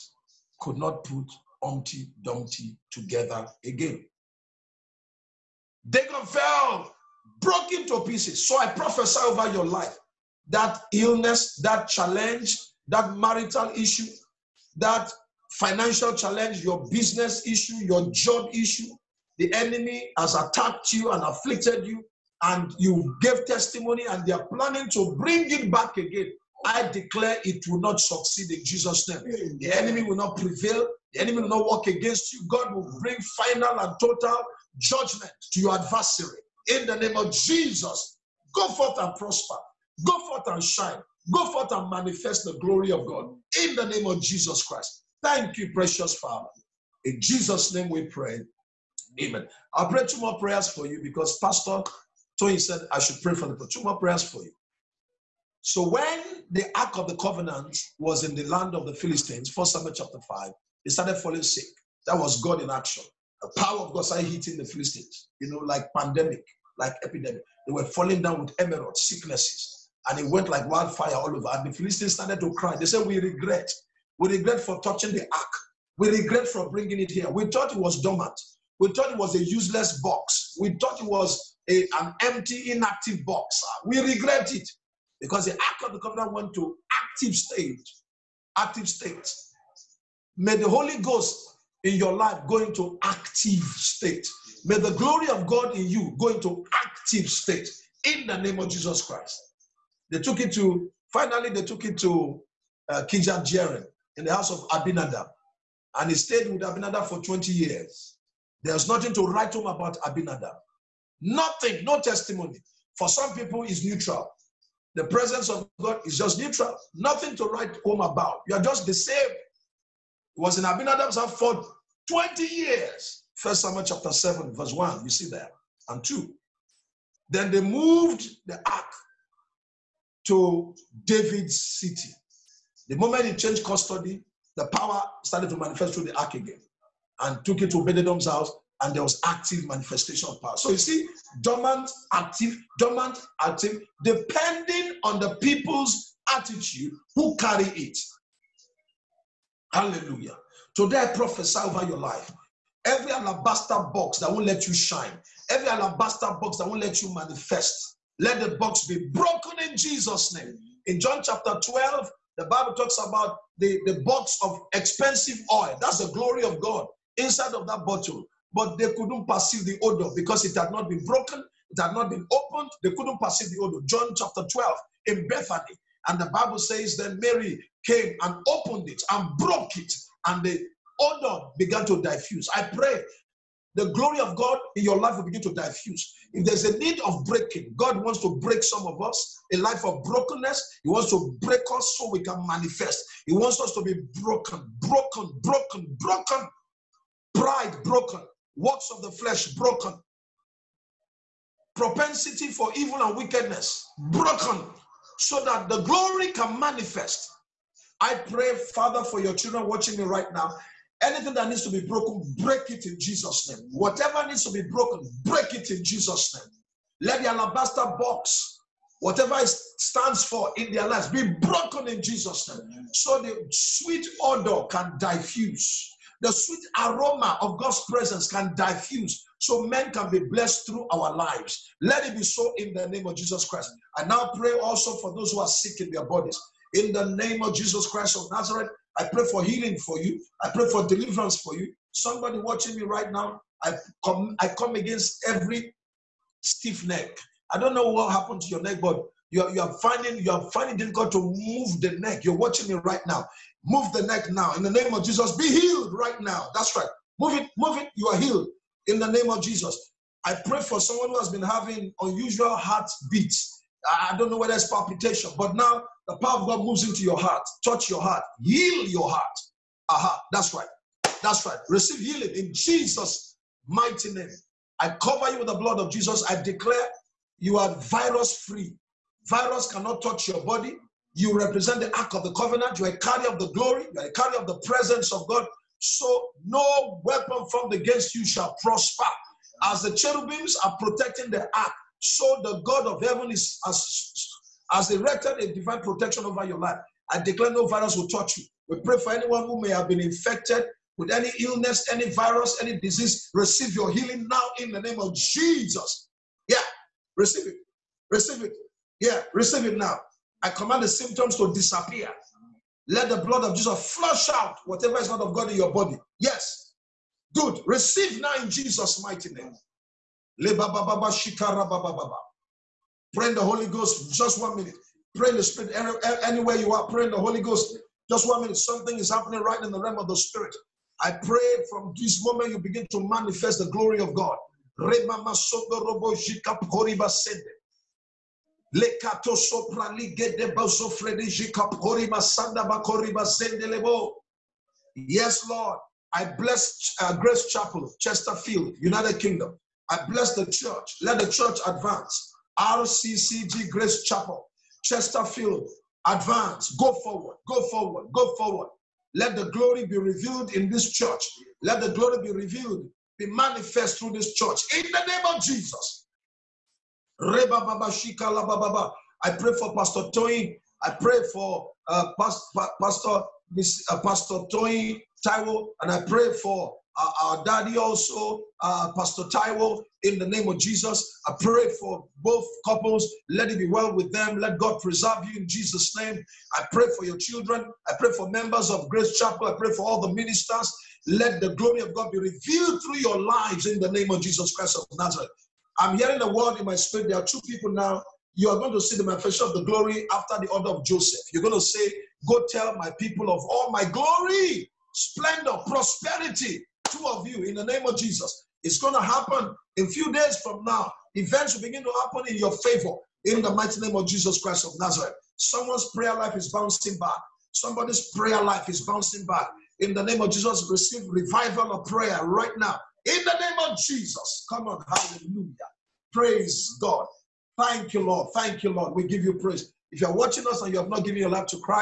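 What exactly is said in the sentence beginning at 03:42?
So the sweet odor can diffuse.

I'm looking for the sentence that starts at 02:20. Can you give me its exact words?
So you see, dormant, active, dormant, active, depending on the people's attitude who carry it.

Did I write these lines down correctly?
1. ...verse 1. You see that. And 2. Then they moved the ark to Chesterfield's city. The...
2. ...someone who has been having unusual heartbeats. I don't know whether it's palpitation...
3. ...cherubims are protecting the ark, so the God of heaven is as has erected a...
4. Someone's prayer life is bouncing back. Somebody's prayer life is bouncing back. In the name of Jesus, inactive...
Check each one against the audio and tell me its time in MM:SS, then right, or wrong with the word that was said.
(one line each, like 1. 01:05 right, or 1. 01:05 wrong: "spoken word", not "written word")
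1. 02:04 wrong: "David", not "Chesterfield"
2. 04:20 right
3. 04:49 right
4. 06:55 wrong: "receive", not "inactive".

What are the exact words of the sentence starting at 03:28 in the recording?
I pray, Father, for your children watching me right now Anything that needs to be broken, break it in Jesus' name.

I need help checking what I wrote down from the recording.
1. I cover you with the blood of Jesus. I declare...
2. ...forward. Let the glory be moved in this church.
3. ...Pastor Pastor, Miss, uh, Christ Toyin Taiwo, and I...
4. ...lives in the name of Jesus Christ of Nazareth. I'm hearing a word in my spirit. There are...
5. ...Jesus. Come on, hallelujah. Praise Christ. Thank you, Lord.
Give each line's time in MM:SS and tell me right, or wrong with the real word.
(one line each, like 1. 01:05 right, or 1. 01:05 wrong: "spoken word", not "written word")
1. 04:34 right
2. 05:58 wrong: "revealed", not "moved"
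3. 06:12 wrong: "Pastor", not "Christ"
4. 06:33 right
5. 07:03 wrong: "God", not "Christ".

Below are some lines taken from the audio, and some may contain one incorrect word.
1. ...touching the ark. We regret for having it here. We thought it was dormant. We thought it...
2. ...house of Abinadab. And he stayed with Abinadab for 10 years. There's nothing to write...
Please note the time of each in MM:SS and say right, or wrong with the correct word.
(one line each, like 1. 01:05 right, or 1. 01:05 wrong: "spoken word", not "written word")
1. 01:14 wrong: "bringing", not "having"
2. 01:44 wrong: "20", not "10".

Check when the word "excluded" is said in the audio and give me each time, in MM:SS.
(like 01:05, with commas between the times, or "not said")
not said.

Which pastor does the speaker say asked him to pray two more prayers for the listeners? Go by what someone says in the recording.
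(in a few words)
Pastor Tony.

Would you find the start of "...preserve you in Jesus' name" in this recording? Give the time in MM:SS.
06:24.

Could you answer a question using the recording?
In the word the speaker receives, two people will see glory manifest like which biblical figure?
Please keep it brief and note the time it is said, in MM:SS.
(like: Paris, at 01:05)
Joseph, at 06:40.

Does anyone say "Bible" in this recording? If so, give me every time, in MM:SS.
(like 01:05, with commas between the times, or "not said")
02:42, 02:56.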